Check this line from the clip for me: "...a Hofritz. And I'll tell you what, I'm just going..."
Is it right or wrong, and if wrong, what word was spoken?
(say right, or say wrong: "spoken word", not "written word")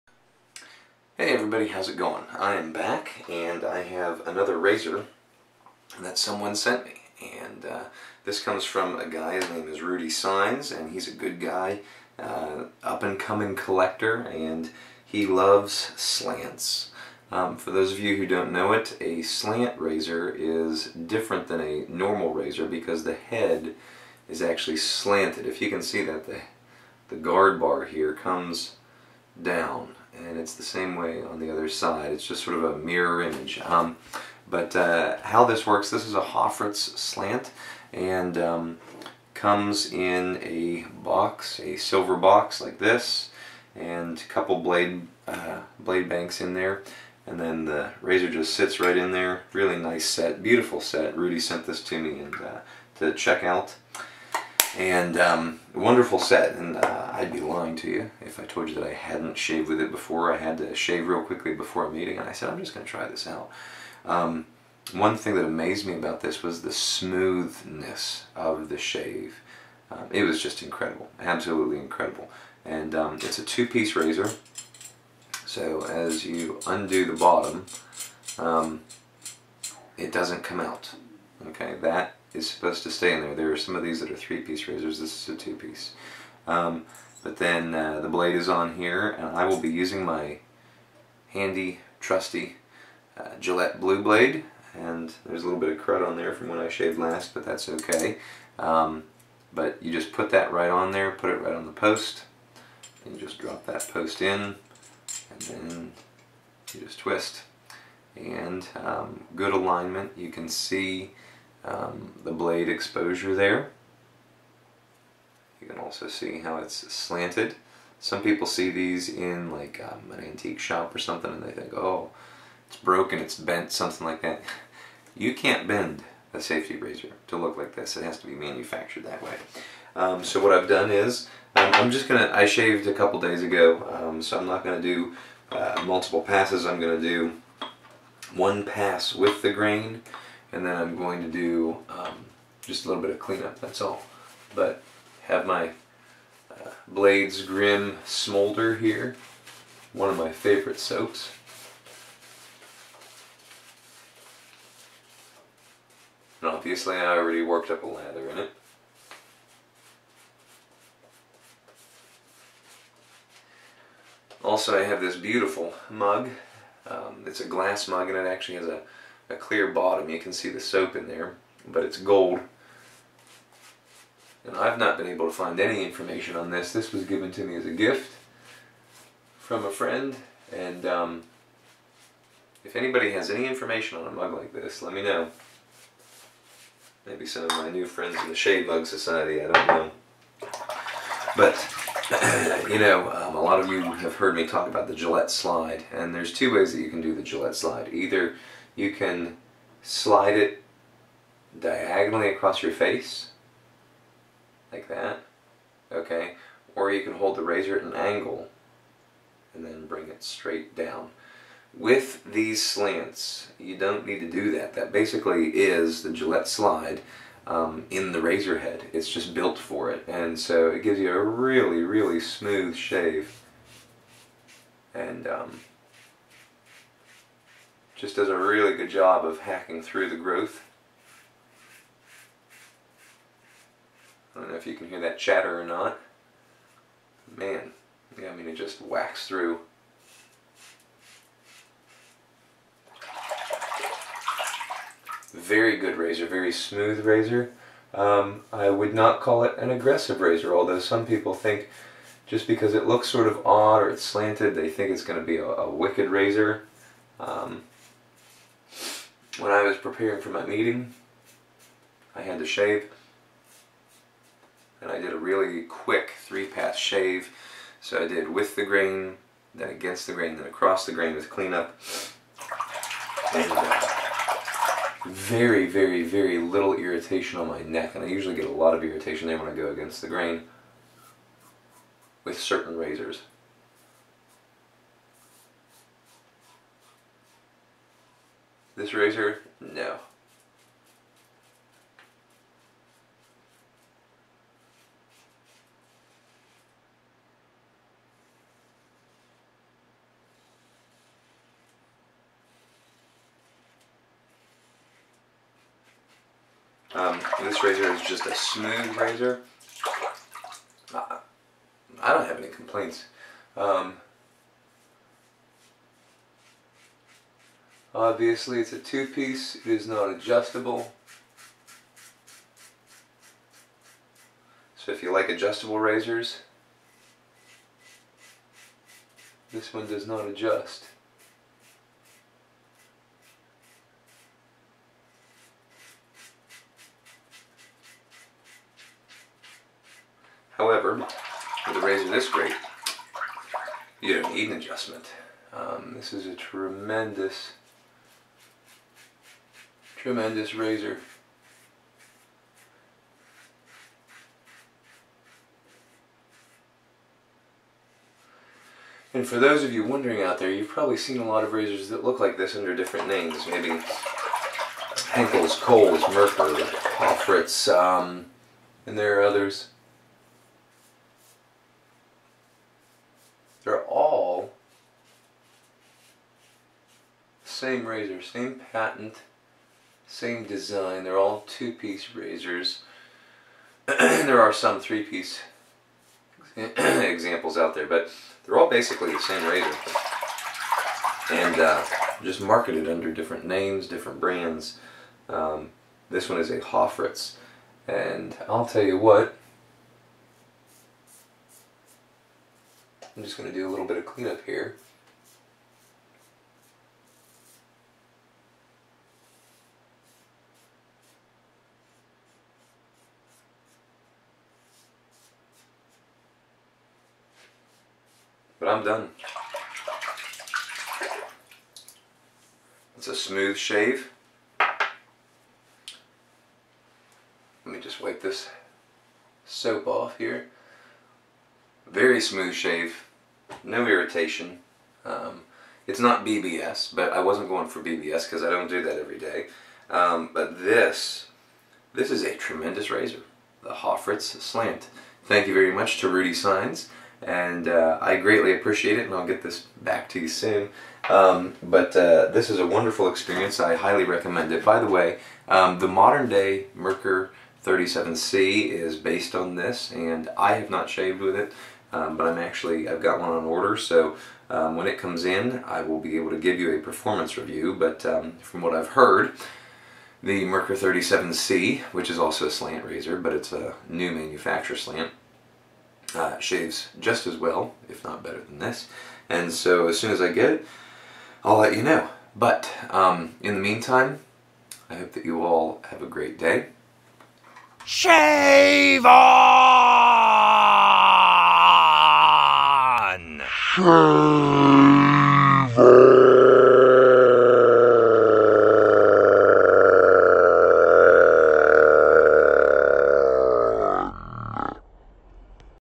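right.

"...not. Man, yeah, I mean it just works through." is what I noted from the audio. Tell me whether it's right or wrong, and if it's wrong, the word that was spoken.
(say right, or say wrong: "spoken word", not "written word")
wrong: "whacks", not "works".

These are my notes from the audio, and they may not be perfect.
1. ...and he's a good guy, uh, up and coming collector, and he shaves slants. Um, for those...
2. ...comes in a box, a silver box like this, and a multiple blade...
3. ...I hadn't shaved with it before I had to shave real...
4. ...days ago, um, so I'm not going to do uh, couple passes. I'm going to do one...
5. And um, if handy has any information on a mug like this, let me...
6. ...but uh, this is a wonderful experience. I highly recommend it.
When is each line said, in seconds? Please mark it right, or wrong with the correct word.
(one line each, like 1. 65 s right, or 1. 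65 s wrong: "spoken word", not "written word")
1. 10 s wrong: "loves", not "shaves"
2. 39 s wrong: "couple", not "multiple"
3. 58 s right
4. 133 s wrong: "multiple", not "couple"
5. 180 s wrong: "anybody", not "handy"
6. 451 s right.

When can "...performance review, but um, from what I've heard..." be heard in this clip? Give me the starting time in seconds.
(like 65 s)
466 s.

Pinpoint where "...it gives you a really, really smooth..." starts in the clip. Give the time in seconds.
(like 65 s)
220 s.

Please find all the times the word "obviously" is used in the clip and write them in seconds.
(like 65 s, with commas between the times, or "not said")
156 s, 318 s.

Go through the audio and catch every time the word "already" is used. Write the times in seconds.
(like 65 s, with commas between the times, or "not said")
157 s.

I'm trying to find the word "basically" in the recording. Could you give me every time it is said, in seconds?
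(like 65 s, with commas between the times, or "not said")
214 s, 388 s.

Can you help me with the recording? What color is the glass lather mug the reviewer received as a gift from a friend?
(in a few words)
gold.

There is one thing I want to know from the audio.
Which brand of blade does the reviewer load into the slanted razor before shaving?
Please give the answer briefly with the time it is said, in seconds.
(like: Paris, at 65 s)
Gillette Blue Blade, at 93 s.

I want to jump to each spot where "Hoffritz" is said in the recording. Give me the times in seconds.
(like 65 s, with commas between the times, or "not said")
36 s, 366 s, 443 s.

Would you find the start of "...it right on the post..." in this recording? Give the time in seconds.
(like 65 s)
101 s.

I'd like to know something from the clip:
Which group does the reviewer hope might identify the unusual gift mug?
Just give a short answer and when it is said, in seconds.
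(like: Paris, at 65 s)
Shade Mug Society, at 188 s.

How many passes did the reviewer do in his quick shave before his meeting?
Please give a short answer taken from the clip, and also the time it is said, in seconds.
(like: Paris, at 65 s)
3, at 266 s.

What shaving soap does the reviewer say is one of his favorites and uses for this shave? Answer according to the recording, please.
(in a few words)
Blades Grim Smolder.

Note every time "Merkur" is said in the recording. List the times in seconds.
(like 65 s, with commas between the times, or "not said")
366 s, 456 s, 470 s.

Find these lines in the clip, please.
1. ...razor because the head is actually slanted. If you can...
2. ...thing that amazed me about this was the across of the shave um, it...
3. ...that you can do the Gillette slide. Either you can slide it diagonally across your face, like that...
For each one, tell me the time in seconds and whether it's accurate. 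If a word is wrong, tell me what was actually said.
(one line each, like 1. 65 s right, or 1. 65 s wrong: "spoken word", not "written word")
1. 22 s right
2. 65 s wrong: "smoothness", not "across"
3. 196 s right.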